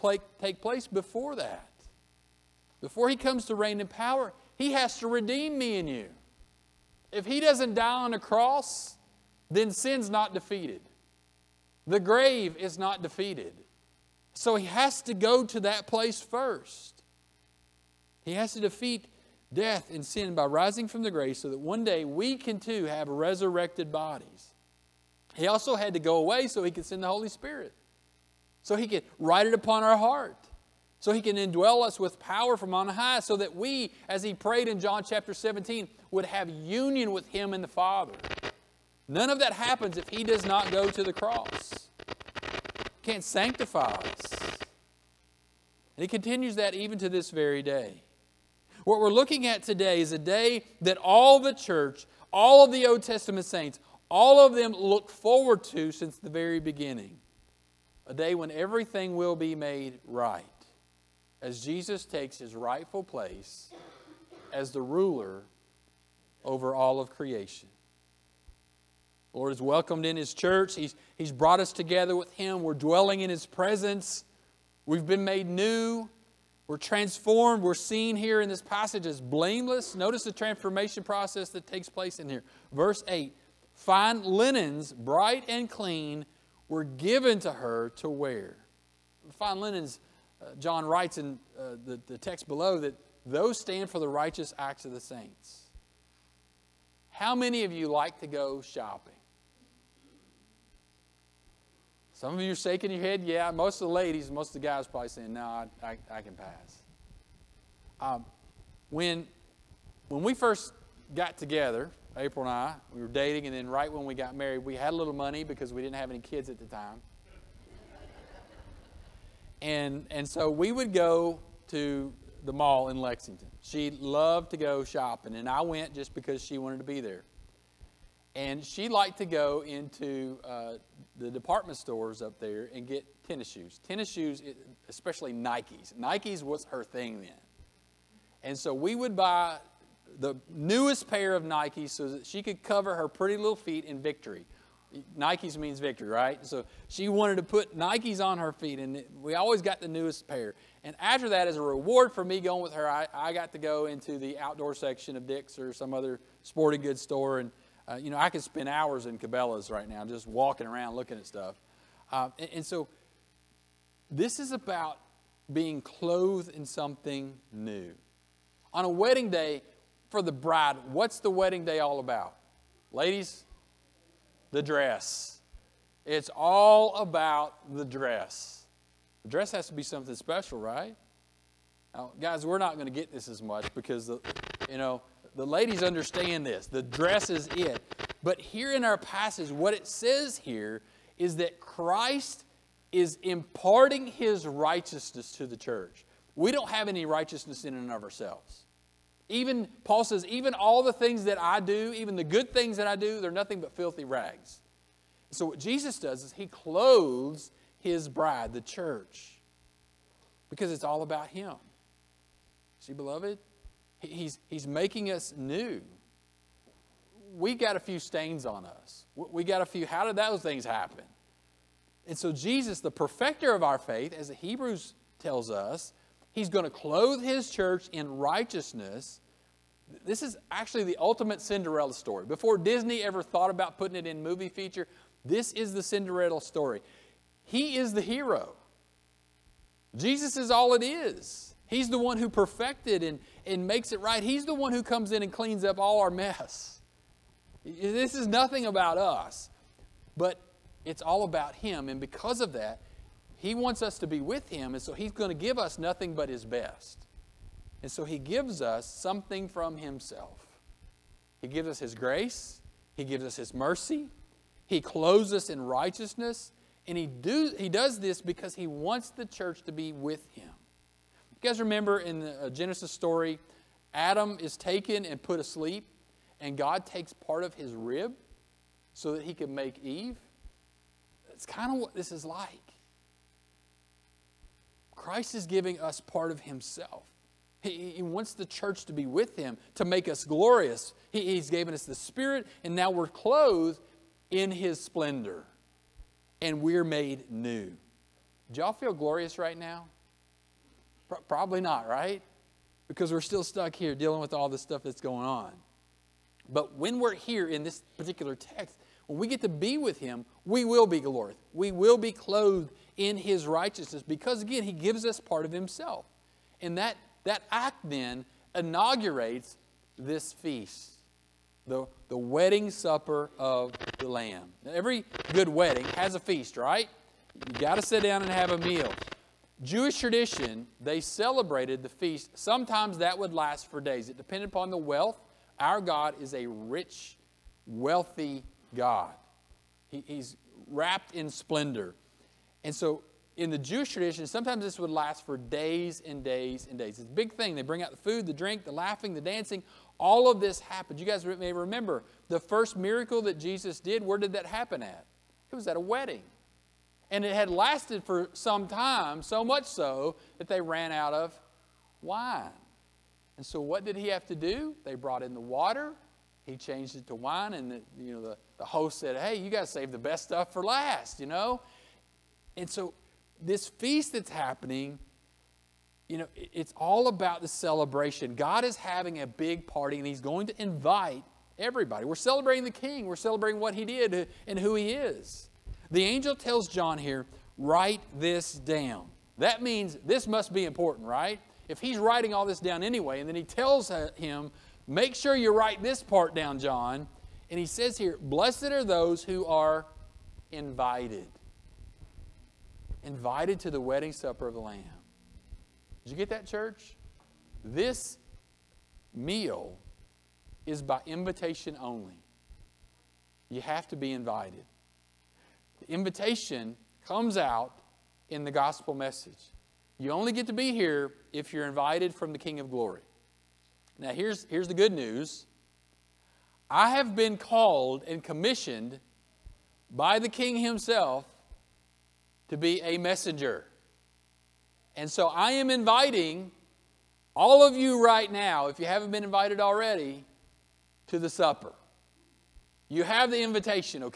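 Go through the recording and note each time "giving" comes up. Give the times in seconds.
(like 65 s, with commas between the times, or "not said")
285 s.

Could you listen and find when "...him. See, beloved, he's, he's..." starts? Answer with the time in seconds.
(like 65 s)
211 s.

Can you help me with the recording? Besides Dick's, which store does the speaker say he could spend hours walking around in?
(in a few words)
Cabela's.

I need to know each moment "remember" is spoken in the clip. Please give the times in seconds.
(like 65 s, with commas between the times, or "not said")
271 s, 351 s.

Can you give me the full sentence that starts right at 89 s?
Fine linens, uh, John writes in uh, the, the text below that those stand for the righteous acts of the saints.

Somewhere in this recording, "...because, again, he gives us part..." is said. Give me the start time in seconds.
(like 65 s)
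314 s.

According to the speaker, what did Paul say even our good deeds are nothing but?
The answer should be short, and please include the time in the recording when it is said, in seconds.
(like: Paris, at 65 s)
filthy rags, at 203 s.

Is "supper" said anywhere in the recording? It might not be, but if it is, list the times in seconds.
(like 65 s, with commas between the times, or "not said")
322 s, 404 s, 441 s.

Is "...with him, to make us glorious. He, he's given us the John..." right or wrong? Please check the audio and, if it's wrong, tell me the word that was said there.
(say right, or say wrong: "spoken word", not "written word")
wrong: "Spirit", not "John".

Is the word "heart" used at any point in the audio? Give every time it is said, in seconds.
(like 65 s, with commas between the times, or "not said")
29 s.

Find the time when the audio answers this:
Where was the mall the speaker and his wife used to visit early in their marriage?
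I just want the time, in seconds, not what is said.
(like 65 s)
122 s.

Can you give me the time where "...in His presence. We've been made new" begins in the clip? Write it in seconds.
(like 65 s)
73 s.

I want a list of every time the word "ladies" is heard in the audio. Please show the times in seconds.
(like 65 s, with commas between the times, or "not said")
103 s, 172 s, 185 s.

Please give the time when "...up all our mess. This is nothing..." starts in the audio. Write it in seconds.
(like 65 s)
245 s.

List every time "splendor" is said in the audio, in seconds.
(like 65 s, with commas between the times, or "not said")
294 s, 341 s.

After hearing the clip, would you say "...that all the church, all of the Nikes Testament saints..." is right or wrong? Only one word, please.
wrong.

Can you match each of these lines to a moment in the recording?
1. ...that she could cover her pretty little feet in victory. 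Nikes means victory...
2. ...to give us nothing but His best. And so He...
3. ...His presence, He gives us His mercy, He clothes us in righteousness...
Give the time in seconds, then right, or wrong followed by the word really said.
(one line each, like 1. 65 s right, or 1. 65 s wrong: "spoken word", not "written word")
1. 142 s right
2. 255 s right
3. 261 s wrong: "grace", not "presence".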